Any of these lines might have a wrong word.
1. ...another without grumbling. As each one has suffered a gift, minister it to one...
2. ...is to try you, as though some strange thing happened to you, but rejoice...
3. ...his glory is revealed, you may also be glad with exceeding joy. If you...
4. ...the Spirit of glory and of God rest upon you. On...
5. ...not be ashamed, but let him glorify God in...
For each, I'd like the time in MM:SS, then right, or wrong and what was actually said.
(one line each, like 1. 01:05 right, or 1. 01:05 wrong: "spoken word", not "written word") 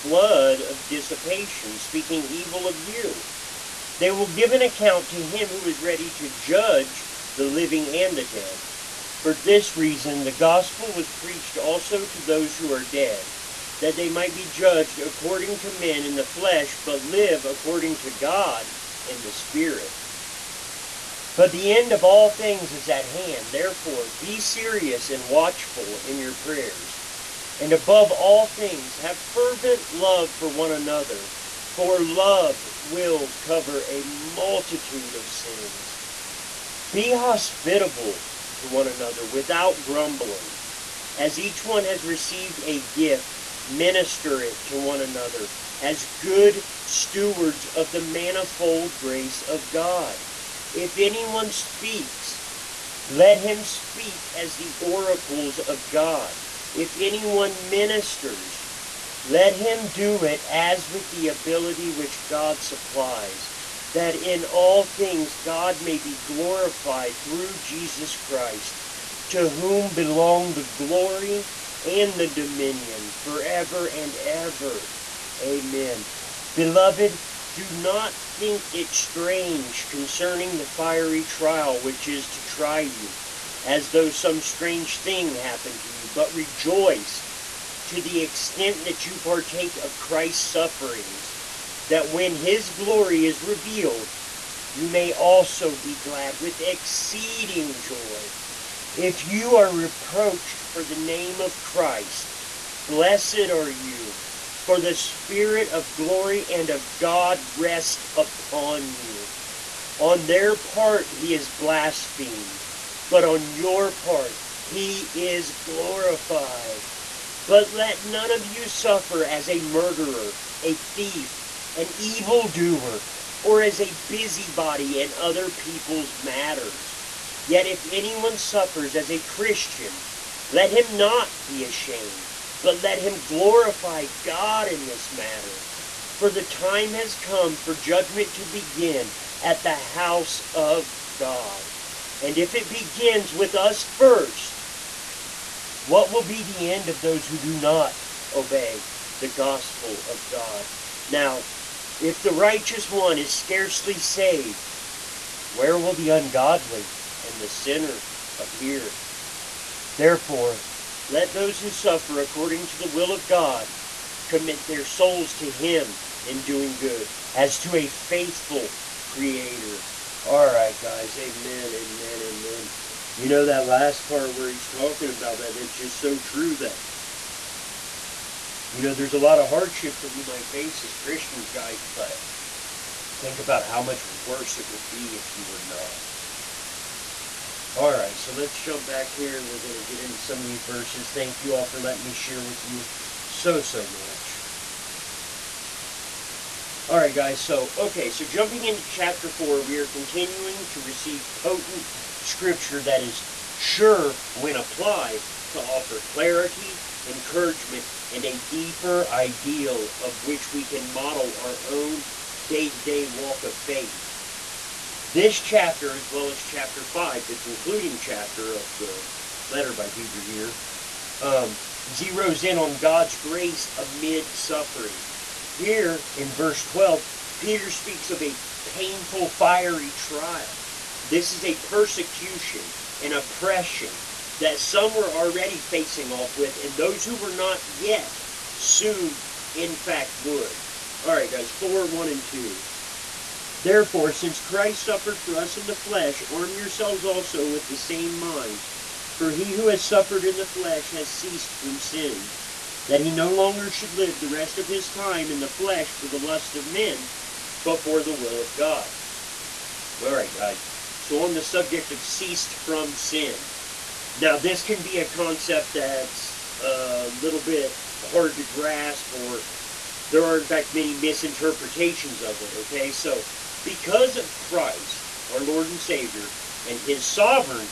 1. 00:38 wrong: "received", not "suffered"
2. 01:22 right
3. 01:32 right
4. 01:44 right
5. 02:10 right.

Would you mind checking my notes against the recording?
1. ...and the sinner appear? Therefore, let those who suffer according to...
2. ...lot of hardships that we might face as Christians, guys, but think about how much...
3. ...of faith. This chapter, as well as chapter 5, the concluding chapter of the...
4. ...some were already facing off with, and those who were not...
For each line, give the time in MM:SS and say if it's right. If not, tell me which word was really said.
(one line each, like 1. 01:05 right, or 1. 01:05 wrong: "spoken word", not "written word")
1. 02:37 right
2. 02:59 right
3. 03:33 right
4. 03:54 right.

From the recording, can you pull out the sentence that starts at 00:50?
If anyone speaks, let him speak as the oracles of God.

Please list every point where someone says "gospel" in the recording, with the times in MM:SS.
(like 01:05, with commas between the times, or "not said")
00:10, 02:29.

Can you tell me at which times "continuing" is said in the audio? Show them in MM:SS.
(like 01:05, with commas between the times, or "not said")
03:19.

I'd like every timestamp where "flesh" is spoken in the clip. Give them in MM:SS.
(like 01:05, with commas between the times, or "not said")
00:16, 04:05, 04:10, 04:15.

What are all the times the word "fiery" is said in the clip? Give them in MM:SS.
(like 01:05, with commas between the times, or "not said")
01:20, 03:49.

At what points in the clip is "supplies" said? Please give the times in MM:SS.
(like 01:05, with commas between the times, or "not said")
01:02.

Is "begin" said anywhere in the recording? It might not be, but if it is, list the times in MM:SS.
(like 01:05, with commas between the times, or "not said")
02:18, 02:22.